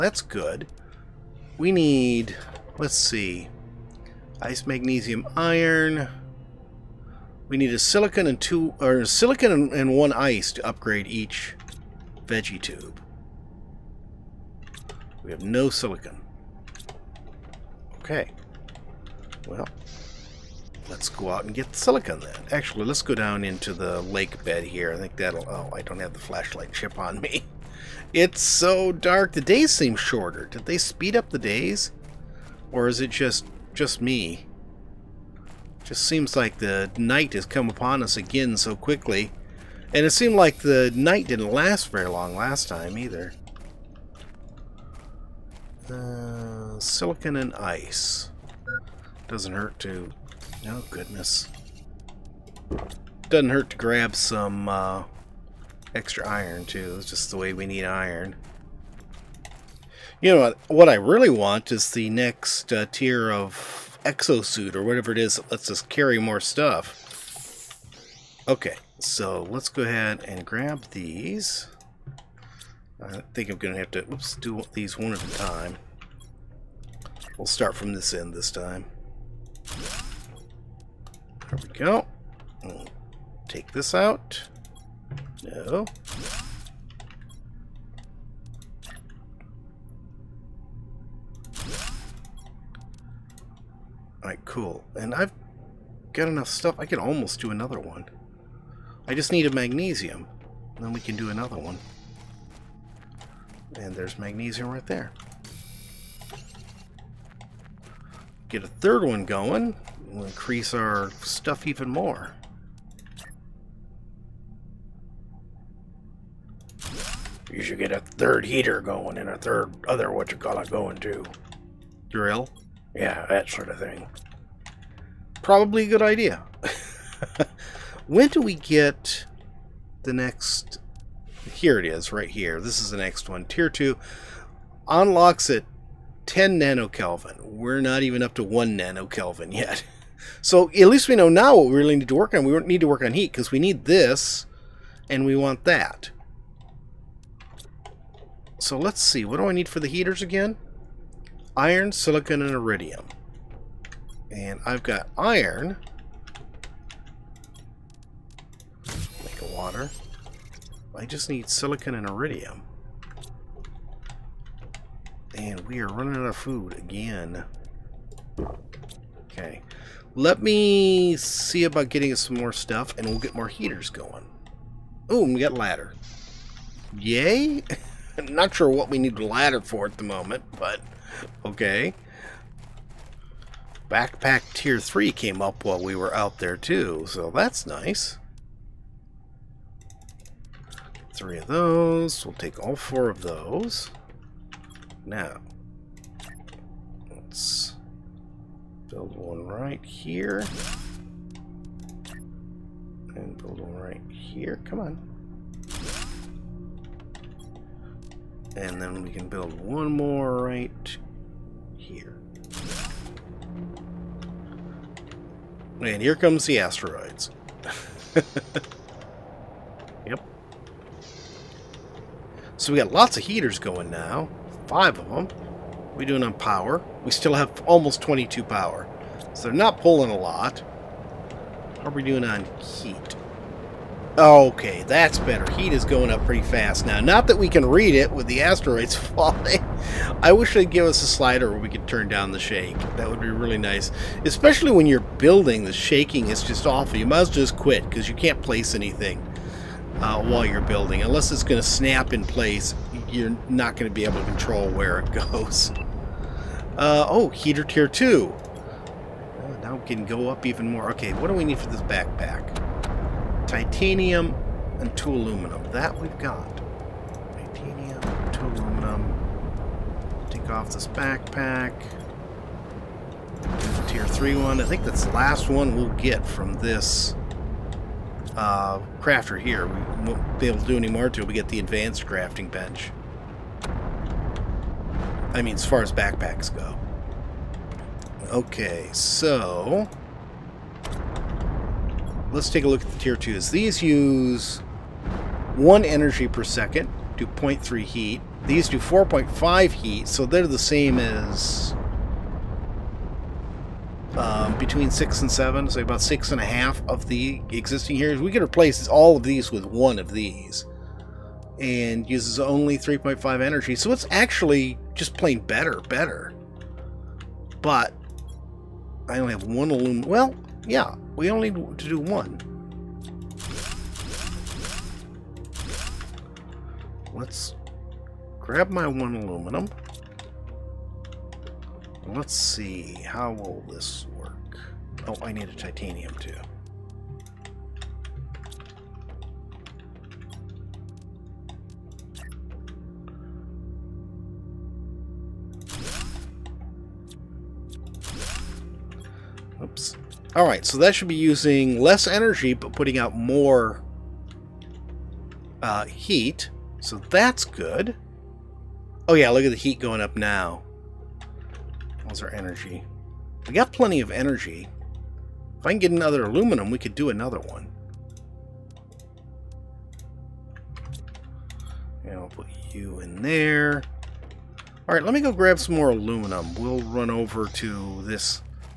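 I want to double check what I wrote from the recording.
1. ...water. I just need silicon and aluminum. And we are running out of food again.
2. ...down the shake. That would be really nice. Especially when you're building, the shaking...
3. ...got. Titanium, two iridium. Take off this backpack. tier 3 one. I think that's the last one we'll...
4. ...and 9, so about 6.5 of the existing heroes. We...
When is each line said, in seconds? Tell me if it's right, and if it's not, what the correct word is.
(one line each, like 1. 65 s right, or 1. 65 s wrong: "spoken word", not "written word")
1. 159 s wrong: "iridium", not "aluminum"
2. 242 s right
3. 266 s wrong: "aluminum", not "iridium"
4. 305 s wrong: "7", not "9".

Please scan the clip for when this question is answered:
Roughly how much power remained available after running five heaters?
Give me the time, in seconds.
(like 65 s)
227 s.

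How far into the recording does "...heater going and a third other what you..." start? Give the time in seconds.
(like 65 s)
118 s.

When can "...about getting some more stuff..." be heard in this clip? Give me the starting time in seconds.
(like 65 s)
171 s.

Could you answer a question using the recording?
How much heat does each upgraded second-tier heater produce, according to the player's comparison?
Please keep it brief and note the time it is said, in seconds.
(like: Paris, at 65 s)
4.5, at 298 s.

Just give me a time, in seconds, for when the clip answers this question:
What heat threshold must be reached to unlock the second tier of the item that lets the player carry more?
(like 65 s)
136 s.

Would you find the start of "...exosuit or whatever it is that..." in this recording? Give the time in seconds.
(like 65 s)
64 s.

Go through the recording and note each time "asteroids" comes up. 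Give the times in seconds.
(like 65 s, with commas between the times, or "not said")
216 s, 238 s.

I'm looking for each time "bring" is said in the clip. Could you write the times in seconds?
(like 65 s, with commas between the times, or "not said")
not said.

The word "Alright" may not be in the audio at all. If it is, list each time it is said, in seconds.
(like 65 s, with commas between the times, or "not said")
94 s, 350 s, 374 s.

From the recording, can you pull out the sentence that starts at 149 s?
What do I need for the heaters again?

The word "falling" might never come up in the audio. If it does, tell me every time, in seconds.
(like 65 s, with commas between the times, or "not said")
238 s.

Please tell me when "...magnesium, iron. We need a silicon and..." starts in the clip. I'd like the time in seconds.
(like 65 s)
4 s.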